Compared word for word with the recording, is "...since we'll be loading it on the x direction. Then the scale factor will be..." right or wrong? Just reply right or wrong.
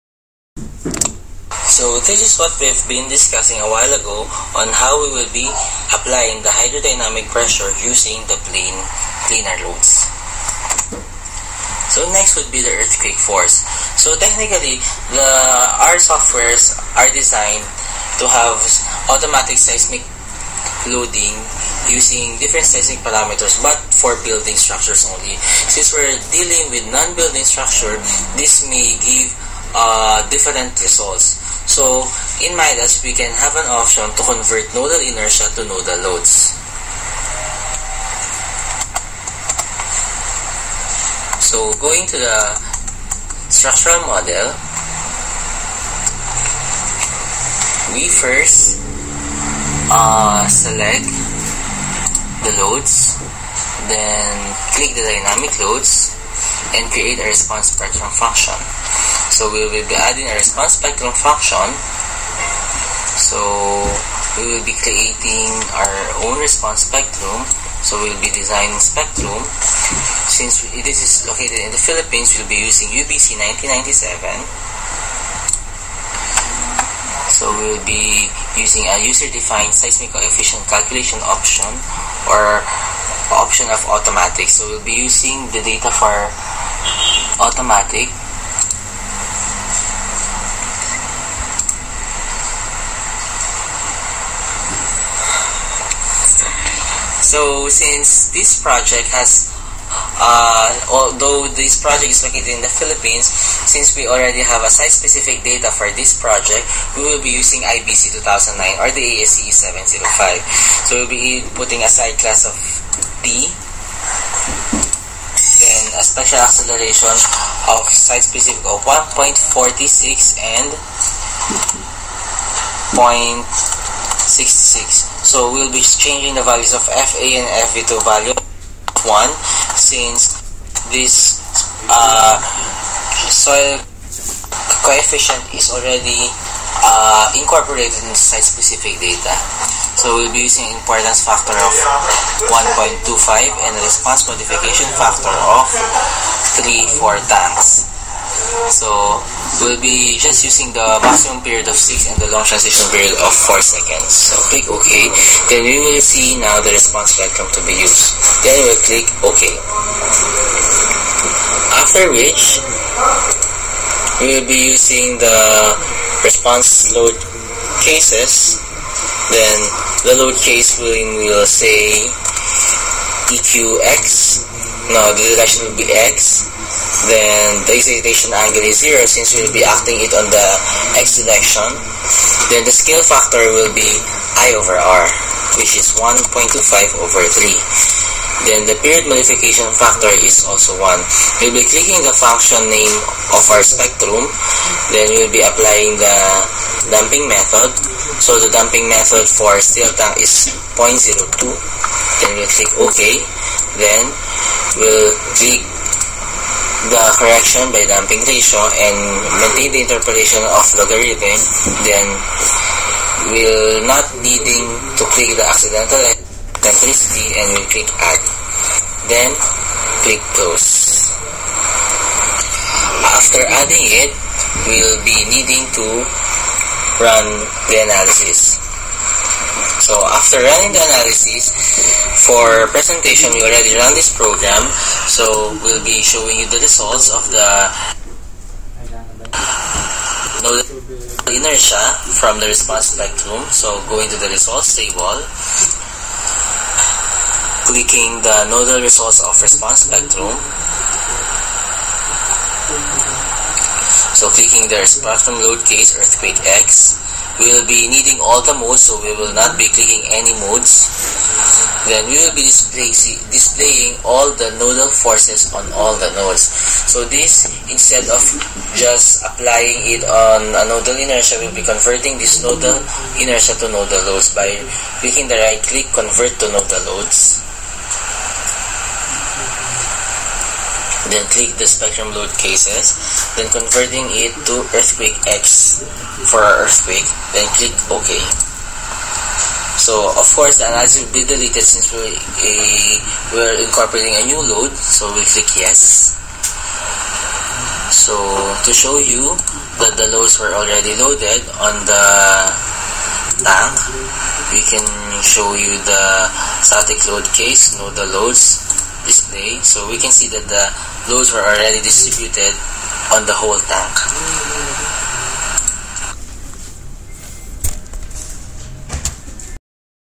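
wrong.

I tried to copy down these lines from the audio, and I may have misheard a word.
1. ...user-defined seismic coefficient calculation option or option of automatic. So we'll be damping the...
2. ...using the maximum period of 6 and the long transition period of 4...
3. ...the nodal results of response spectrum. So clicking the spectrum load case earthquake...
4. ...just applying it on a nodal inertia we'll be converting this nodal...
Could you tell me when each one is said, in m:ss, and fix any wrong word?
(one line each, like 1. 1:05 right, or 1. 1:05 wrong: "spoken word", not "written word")
1. 1:19 wrong: "using", not "damping"
2. 2:30 right
3. 4:08 right
4. 4:28 right.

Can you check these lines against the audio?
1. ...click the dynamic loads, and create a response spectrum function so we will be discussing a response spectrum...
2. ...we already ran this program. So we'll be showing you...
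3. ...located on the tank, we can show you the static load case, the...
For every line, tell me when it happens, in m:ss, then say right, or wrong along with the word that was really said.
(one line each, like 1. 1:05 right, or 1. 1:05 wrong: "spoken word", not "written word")
1. 0:54 wrong: "adding", not "discussing"
2. 3:53 right
3. 5:00 wrong: "loaded", not "located".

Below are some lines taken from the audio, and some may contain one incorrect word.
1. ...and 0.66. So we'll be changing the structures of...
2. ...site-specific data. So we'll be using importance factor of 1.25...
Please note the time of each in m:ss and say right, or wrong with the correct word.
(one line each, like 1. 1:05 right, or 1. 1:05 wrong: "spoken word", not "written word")
1. 2:00 wrong: "values", not "structures"
2. 2:18 right.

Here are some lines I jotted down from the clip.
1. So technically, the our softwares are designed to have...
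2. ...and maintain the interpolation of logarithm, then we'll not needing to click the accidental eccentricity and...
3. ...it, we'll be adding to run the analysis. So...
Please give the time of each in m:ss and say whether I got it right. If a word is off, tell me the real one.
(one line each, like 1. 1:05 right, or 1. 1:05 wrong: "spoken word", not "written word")
1. 0:13 right
2. 3:28 right
3. 3:44 wrong: "needing", not "adding".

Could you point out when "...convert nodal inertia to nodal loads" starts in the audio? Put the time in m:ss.
0:34.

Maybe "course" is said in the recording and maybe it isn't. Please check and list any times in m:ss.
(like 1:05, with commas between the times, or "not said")
4:50.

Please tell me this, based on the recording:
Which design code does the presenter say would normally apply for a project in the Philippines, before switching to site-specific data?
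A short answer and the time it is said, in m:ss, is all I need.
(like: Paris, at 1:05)
UBC 1997, at 1:12.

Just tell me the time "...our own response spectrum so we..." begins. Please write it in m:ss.
1:05.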